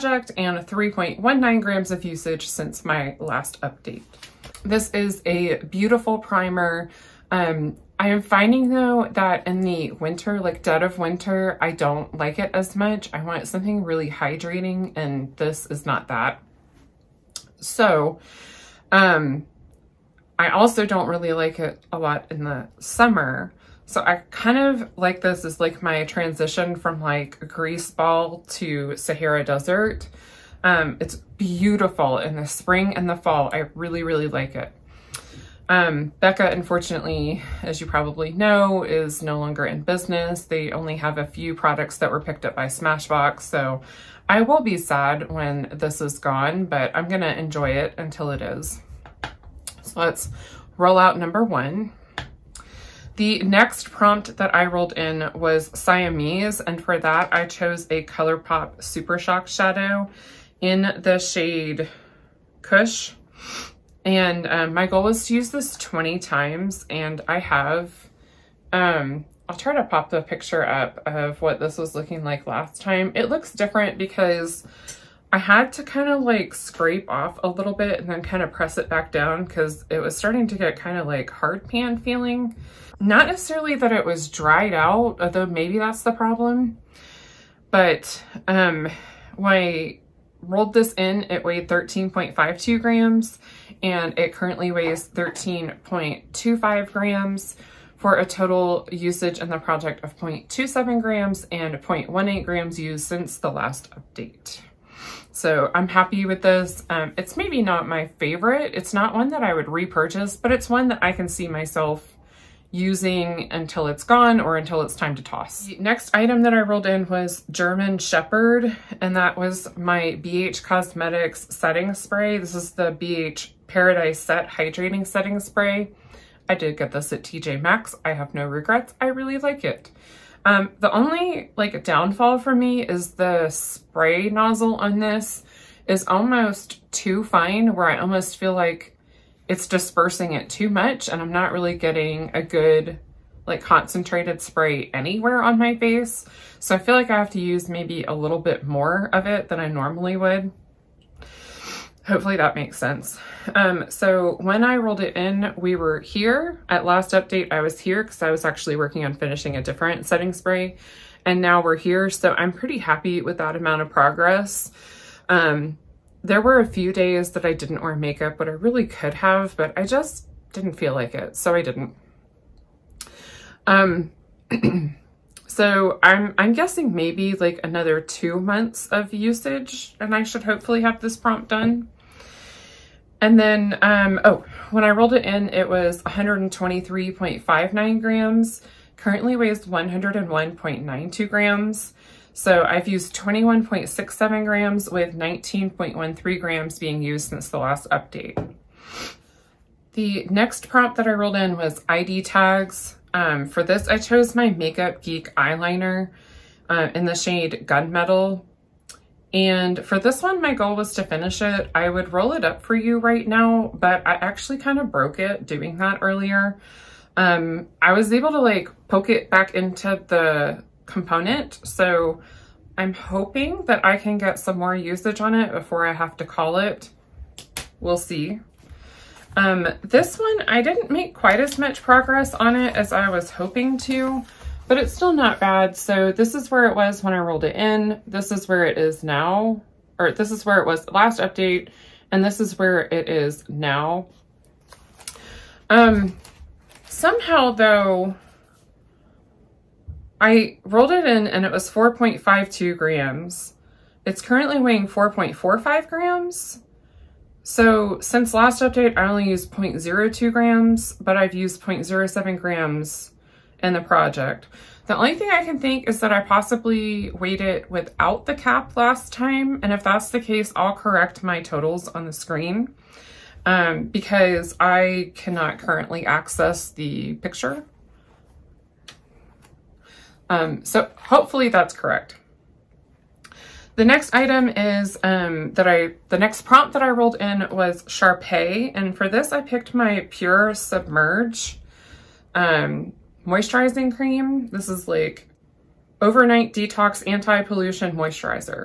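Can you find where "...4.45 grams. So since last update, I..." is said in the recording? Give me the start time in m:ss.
4:14.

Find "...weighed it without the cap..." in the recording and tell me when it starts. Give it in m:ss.
4:27.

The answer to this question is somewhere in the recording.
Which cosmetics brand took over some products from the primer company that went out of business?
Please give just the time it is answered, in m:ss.
0:42.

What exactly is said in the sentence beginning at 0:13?
I want something really hydrating and this is not that.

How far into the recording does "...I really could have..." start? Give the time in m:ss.
2:48.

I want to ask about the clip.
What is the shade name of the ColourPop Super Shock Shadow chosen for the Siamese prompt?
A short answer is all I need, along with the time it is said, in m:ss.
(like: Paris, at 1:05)
Kush, at 1:02.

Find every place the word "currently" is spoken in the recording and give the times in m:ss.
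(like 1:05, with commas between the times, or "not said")
1:34, 3:08, 4:14, 4:35.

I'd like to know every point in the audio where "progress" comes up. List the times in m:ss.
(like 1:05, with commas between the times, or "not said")
2:43, 3:51.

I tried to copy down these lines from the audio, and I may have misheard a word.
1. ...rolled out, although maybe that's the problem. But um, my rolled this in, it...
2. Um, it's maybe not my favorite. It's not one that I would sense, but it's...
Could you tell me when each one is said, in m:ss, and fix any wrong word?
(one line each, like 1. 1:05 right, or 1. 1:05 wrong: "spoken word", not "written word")
1. 1:24 wrong: "dried", not "rolled"
2. 1:46 wrong: "repurchase", not "sense".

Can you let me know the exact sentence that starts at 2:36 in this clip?
At last update, I was here because I was actually working on finishing a different setting spray.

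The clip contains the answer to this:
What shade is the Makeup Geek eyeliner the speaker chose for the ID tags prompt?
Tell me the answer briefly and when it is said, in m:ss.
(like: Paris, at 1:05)
Gunmetal, at 3:27.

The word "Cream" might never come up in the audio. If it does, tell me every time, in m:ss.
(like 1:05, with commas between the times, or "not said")
4:53.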